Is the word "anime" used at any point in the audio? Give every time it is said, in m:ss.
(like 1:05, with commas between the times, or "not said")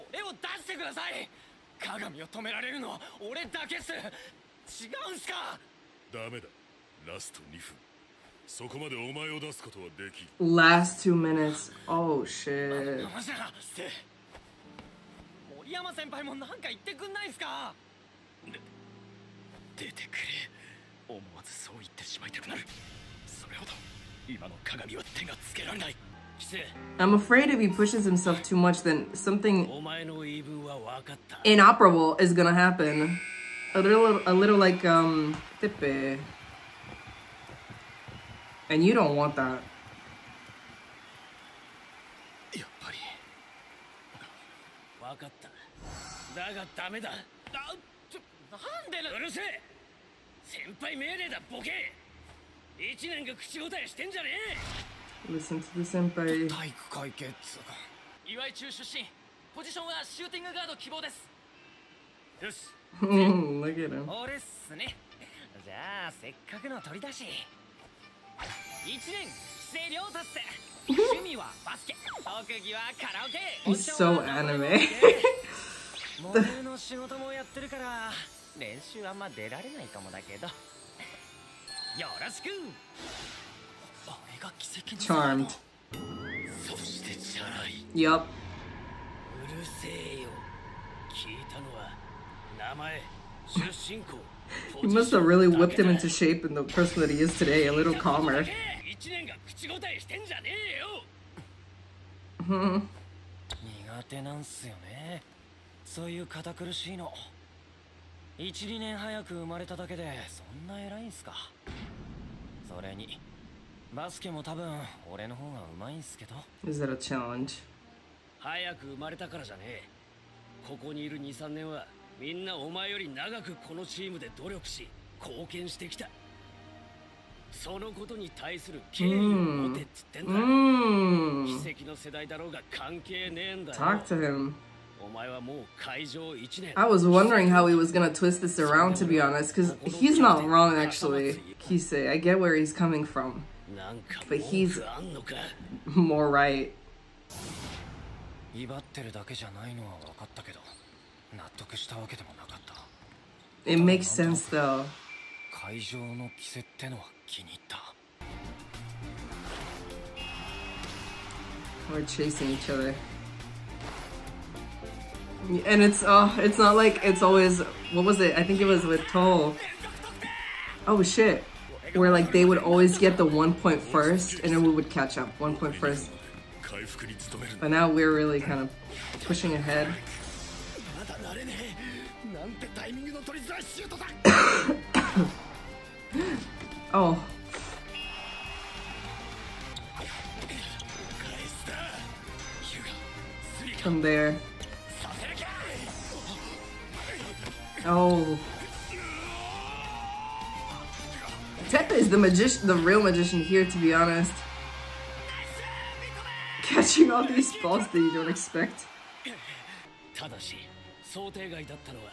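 1:14.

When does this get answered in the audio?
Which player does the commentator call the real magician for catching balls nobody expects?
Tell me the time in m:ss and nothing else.
3:21.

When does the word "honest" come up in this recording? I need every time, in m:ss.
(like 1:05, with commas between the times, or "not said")
2:19, 3:23.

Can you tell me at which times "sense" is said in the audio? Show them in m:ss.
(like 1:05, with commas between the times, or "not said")
2:34.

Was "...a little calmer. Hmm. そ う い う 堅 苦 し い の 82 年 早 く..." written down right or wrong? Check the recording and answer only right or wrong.
wrong.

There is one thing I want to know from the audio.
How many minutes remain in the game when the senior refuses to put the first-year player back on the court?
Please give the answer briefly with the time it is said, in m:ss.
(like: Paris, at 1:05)
2, at 0:07.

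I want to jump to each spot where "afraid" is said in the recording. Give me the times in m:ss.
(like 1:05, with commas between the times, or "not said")
0:27.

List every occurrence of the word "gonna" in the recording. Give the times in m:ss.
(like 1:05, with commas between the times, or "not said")
0:32, 2:17.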